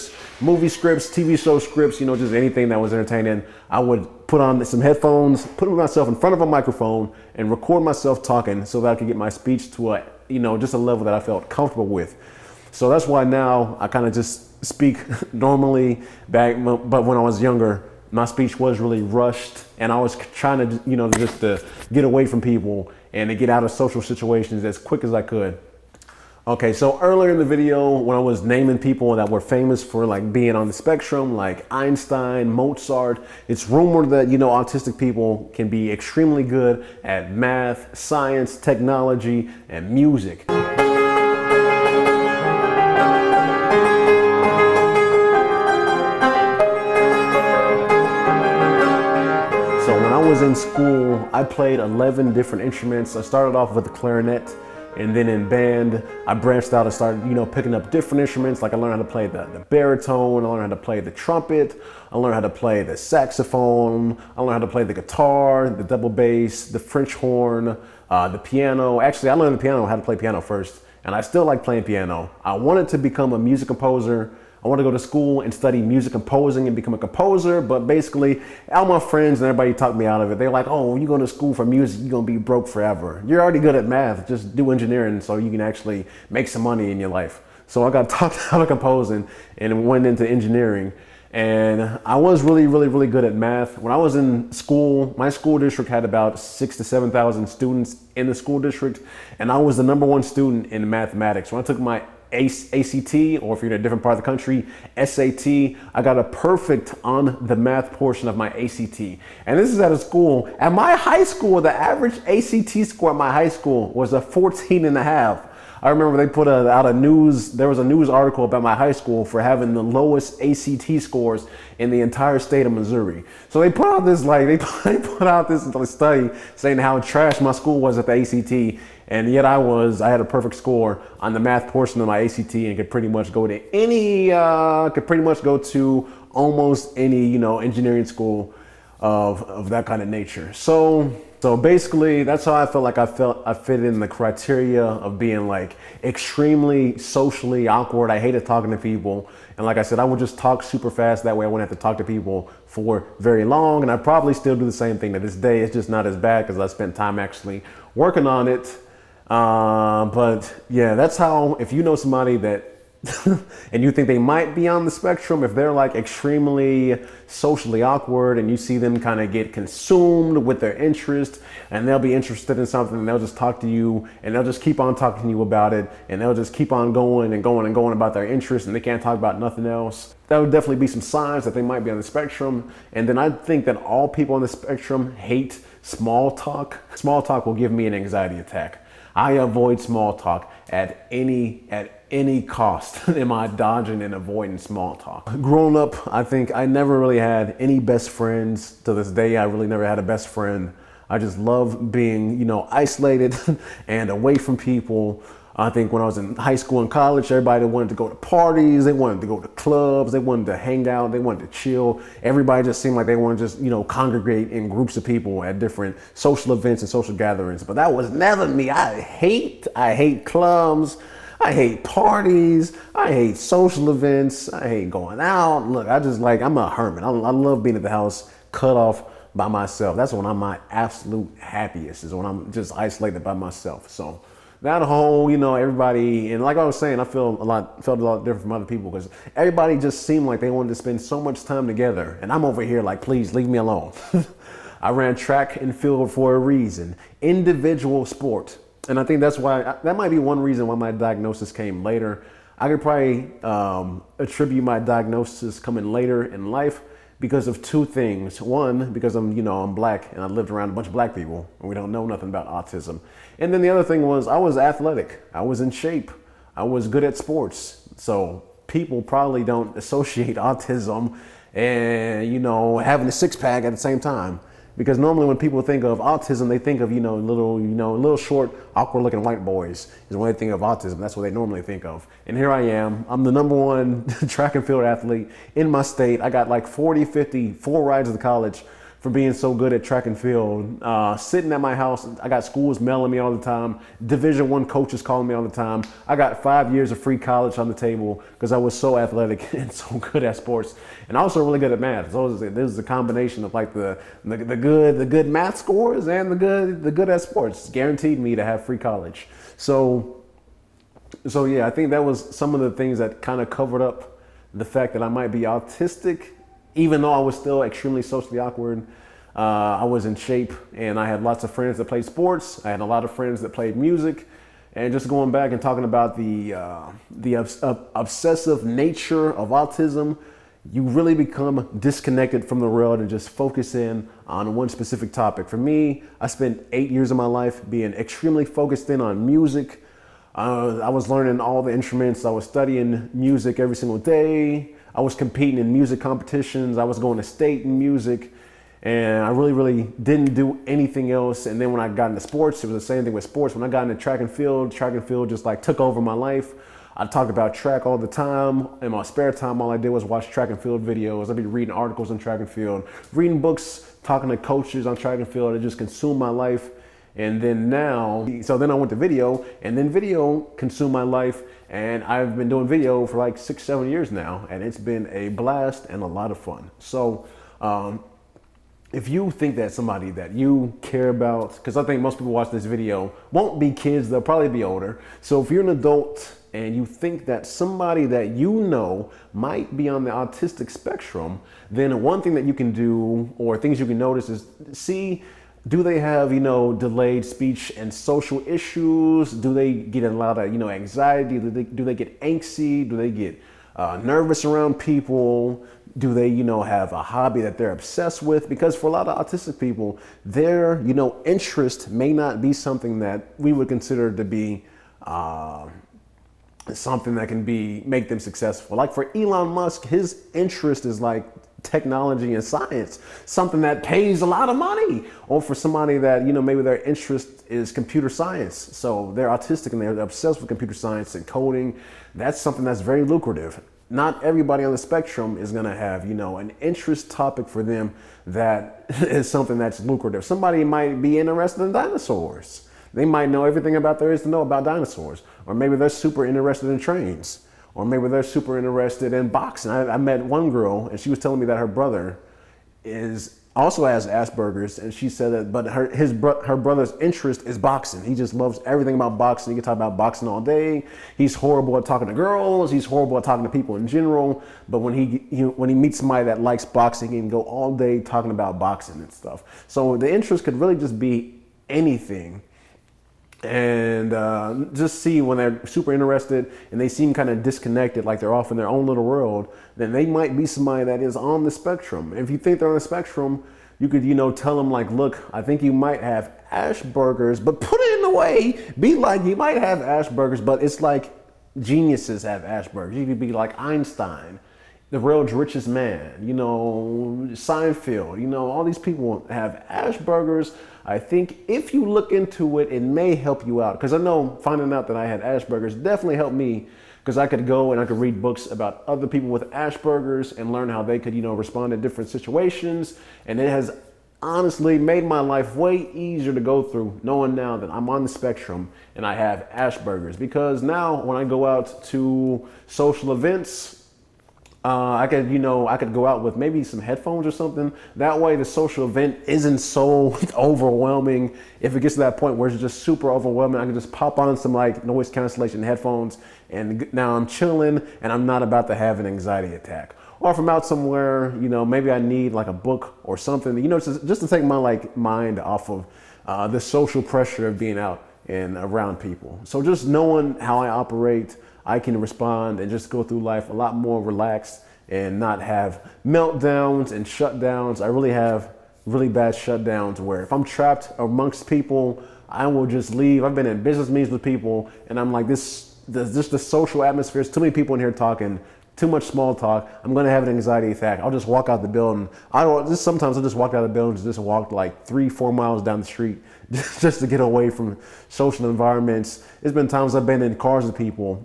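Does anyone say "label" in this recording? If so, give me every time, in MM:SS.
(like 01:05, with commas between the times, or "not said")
not said.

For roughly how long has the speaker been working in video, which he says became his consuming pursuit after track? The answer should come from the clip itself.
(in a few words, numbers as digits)
6 or 7 years.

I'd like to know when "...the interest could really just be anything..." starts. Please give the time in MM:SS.
07:49.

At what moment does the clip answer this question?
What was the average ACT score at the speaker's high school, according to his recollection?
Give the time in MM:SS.
01:54.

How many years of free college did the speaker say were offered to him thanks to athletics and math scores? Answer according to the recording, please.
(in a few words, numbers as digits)
5 years.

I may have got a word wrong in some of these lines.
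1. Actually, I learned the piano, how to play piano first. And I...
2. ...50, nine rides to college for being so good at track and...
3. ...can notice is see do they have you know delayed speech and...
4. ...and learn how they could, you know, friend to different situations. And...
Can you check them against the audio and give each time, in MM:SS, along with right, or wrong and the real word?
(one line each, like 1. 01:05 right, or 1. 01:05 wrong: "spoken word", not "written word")
1. 01:08 right
2. 04:47 wrong: "four", not "nine"
3. 06:33 right
4. 08:30 wrong: "respond", not "friend".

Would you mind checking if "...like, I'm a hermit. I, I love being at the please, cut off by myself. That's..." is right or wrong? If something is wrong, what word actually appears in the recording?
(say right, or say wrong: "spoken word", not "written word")
wrong: "house", not "please".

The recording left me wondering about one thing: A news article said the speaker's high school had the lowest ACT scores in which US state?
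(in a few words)
Missouri.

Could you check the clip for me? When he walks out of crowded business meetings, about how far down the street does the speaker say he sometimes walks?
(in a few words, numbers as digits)
3 or 4 miles.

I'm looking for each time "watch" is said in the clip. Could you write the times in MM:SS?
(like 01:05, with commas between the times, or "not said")
06:00, 06:22.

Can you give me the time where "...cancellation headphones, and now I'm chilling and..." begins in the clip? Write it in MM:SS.
08:55.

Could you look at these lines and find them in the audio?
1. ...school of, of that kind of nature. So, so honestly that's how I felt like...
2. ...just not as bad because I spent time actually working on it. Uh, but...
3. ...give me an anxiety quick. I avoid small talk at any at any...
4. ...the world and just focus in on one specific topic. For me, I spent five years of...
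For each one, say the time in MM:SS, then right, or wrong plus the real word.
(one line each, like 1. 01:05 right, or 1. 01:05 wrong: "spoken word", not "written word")
1. 02:18 wrong: "basically", not "honestly"
2. 02:35 right
3. 03:07 wrong: "attack", not "quick"
4. 05:32 wrong: "eight", not "five".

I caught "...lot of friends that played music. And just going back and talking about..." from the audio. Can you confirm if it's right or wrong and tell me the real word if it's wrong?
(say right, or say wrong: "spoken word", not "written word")
right.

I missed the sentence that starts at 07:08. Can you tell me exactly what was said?
So they're autistic and they're obsessed with computer science and coding.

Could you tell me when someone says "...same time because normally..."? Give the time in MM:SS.
04:33.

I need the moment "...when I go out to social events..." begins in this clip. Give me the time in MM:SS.
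08:41.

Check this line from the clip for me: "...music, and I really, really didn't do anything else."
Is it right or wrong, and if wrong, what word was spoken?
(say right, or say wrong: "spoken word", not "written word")
right.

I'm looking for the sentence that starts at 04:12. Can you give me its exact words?
I could probably um, attribute my diagnosis coming later in life because of two things.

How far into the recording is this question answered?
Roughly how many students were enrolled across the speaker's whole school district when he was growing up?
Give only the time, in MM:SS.
01:36.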